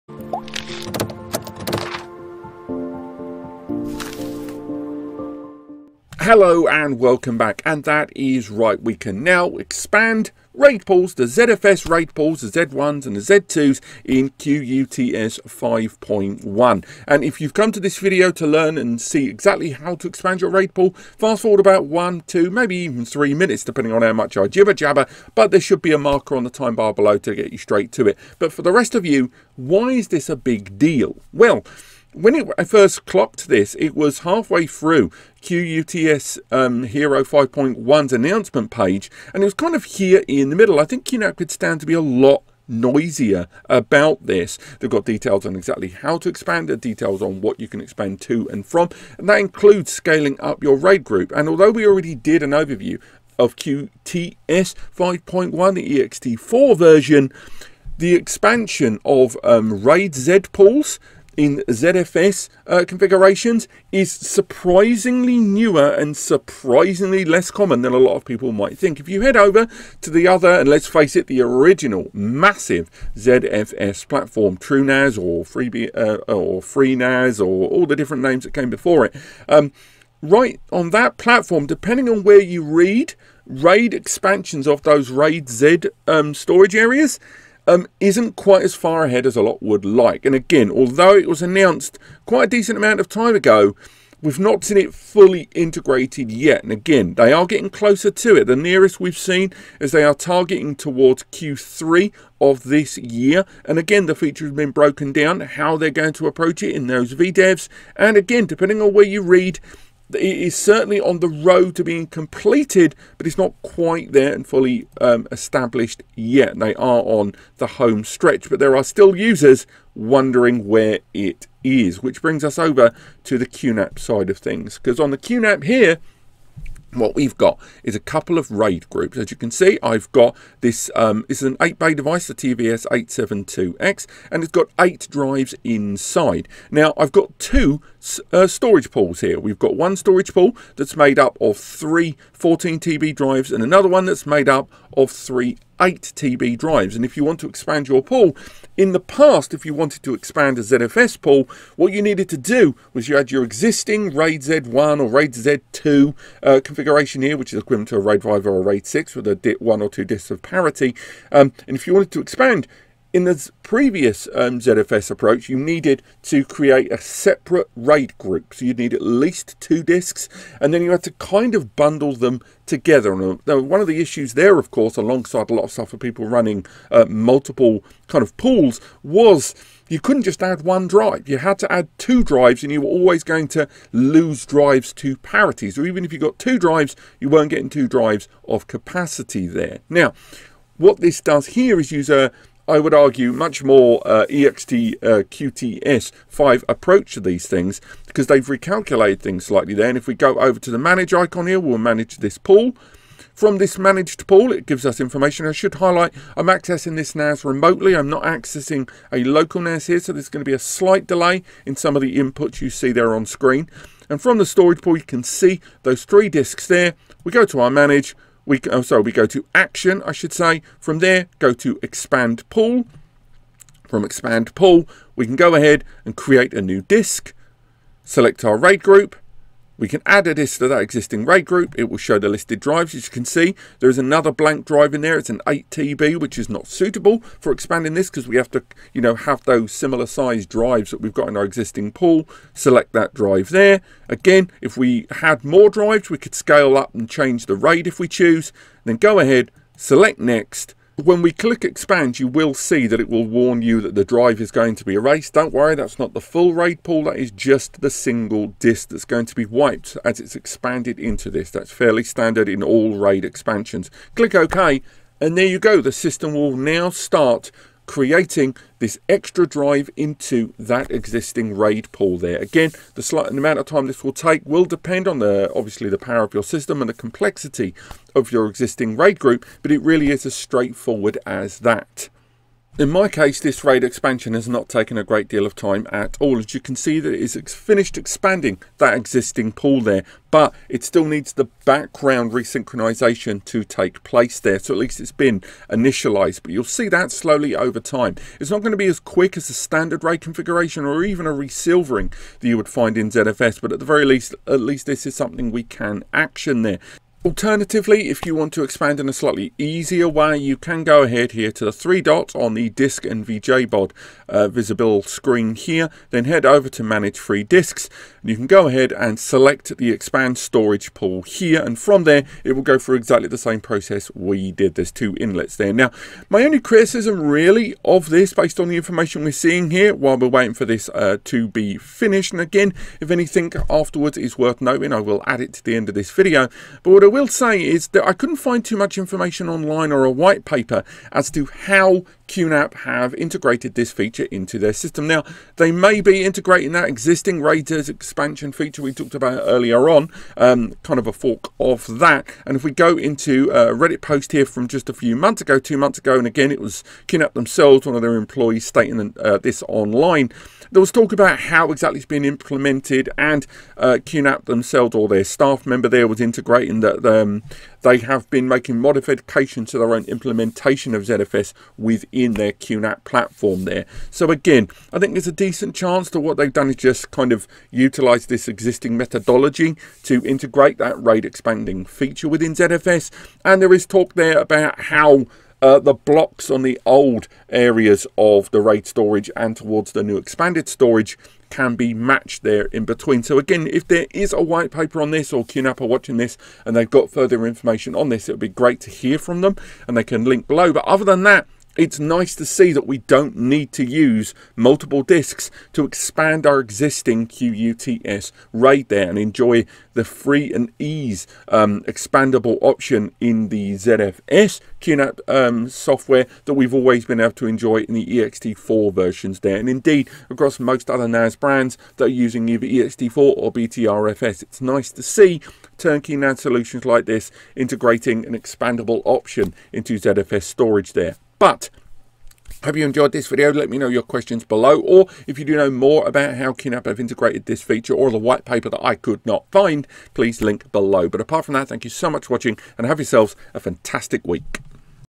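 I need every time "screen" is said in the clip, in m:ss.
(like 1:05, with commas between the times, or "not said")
3:33, 5:15.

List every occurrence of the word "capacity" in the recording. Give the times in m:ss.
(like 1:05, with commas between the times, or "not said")
3:08.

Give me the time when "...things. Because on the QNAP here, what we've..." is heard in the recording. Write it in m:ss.
2:04.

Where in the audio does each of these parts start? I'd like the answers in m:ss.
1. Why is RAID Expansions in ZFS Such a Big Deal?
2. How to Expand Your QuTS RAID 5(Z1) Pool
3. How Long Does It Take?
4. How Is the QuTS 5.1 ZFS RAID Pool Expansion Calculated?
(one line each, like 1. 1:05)
1. 0:30
2. 2:05
3. 4:10
4. 5:30.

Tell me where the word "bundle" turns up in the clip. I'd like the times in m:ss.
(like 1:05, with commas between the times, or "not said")
2:51.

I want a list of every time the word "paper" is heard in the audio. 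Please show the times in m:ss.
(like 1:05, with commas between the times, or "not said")
5:40, 6:34, 7:18.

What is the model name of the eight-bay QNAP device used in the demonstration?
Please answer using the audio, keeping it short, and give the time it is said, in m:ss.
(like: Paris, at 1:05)
TVS872X, at 2:12.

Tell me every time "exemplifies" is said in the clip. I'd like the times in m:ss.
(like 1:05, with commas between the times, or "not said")
not said.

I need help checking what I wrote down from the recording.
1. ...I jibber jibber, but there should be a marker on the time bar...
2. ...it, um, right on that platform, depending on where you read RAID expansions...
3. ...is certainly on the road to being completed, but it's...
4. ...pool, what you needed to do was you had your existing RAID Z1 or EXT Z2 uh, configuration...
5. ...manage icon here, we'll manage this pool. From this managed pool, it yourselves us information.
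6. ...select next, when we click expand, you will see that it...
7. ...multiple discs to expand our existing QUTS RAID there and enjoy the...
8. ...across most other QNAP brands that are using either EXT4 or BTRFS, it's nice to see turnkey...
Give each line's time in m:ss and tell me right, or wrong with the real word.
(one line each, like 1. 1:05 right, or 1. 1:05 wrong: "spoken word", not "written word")
1. 0:24 wrong: "jabber", not "jibber"
2. 1:19 right
3. 1:50 right
4. 2:31 wrong: "RAID", not "EXT"
5. 3:20 wrong: "gives", not "yourselves"
6. 4:09 right
7. 6:44 right
8. 7:00 wrong: "NAS", not "QNAP".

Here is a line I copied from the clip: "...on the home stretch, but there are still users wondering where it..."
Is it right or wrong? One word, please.
right.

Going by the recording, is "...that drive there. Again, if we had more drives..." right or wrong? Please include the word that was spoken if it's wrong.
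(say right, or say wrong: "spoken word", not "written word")
right.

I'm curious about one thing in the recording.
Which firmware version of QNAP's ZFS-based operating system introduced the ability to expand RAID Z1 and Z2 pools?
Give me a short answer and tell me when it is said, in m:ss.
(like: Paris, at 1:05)
QuTS hero 5.1, at 0:14.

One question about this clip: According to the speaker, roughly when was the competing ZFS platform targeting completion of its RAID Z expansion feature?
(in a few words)
Q3.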